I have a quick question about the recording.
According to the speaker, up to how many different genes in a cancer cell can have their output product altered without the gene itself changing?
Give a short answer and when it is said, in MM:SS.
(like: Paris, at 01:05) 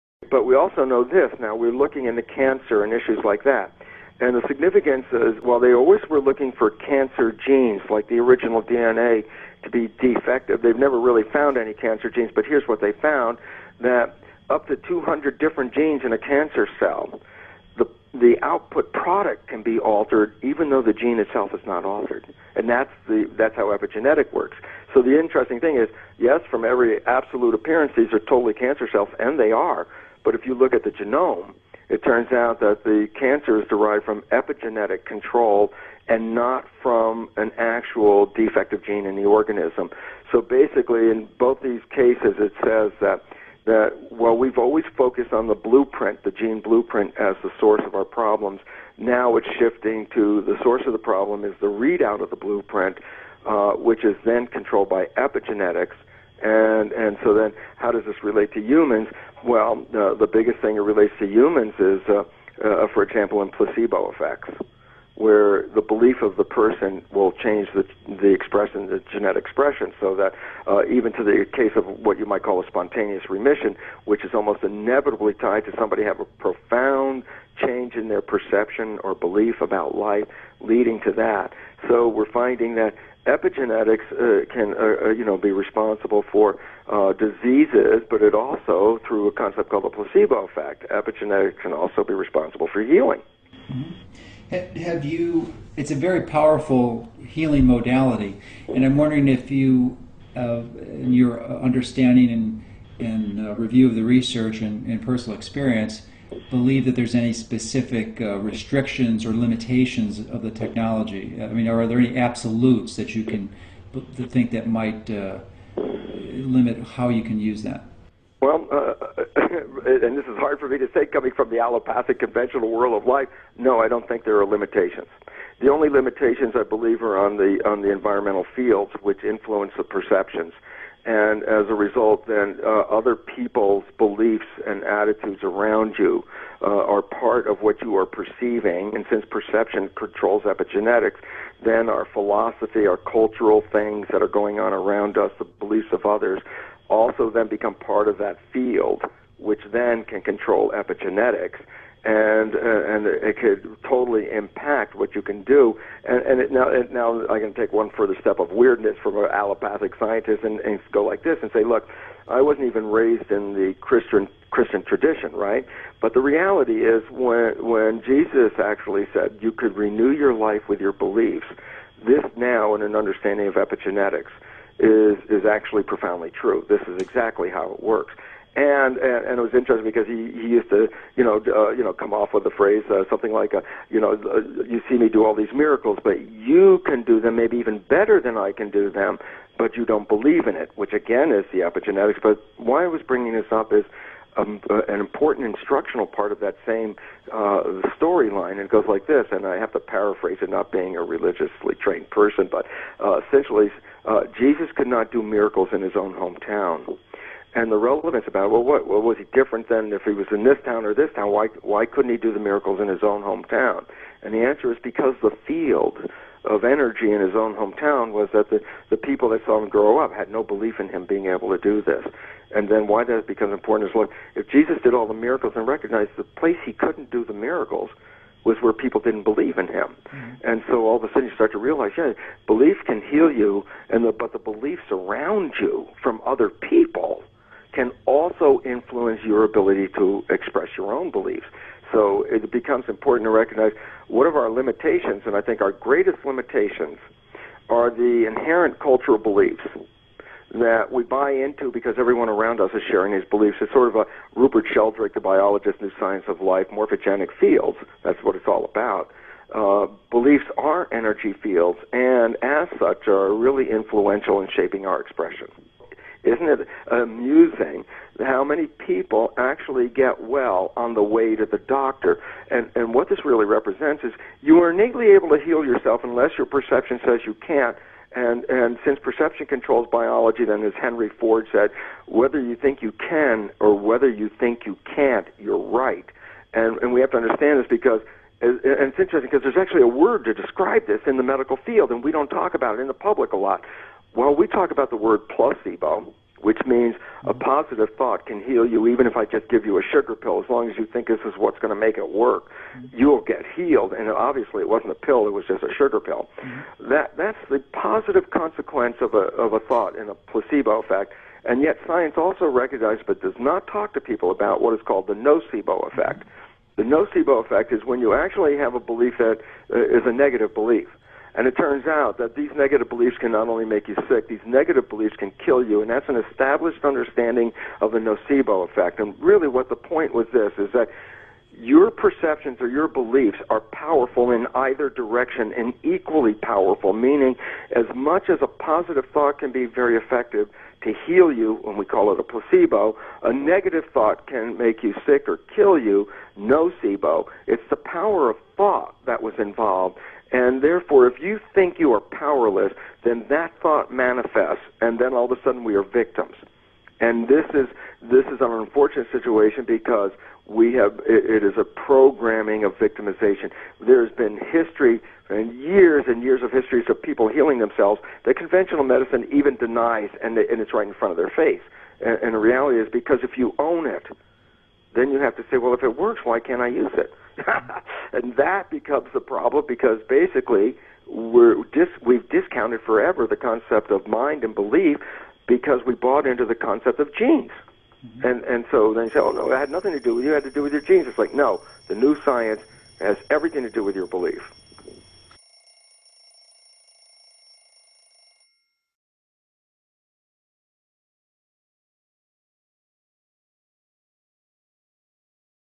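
200, at 00:14.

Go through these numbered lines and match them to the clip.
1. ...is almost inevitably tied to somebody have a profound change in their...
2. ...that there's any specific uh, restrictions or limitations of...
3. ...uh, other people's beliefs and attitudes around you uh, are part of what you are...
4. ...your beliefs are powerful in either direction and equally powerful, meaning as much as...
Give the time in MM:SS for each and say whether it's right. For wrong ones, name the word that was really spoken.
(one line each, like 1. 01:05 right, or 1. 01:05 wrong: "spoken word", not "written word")
1. 01:14 right
2. 01:46 right
3. 02:12 right
4. 05:32 right.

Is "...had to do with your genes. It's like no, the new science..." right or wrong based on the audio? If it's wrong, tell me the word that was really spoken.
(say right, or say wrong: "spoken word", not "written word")
right.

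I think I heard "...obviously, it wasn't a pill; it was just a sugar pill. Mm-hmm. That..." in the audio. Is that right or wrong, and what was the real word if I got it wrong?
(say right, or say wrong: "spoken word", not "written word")
right.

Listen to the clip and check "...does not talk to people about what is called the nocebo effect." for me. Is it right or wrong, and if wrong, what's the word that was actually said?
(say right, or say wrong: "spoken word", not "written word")
right.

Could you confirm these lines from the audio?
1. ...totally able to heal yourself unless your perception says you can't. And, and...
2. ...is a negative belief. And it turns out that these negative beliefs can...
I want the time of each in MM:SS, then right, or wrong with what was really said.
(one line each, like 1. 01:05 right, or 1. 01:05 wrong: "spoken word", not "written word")
1. 04:34 wrong: "innately", not "totally"
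2. 05:19 right.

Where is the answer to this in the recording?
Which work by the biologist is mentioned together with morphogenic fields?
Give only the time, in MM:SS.
04:15.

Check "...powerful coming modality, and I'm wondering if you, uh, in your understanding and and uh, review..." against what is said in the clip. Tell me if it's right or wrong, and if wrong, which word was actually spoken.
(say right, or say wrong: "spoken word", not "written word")
wrong: "healing", not "coming".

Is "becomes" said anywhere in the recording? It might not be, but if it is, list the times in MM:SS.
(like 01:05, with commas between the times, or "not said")
02:27, 03:43, 04:02, 06:18.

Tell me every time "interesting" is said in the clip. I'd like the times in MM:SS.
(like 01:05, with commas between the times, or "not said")
00:25, 02:59, 04:48.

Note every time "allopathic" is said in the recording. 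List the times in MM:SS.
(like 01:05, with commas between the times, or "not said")
02:01, 02:39.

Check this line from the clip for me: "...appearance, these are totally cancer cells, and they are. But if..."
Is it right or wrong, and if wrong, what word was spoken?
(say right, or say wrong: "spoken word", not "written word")
right.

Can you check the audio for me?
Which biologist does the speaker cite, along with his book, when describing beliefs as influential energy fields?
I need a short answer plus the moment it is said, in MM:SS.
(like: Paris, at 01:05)
Rupert Sheldrake, at 04:14.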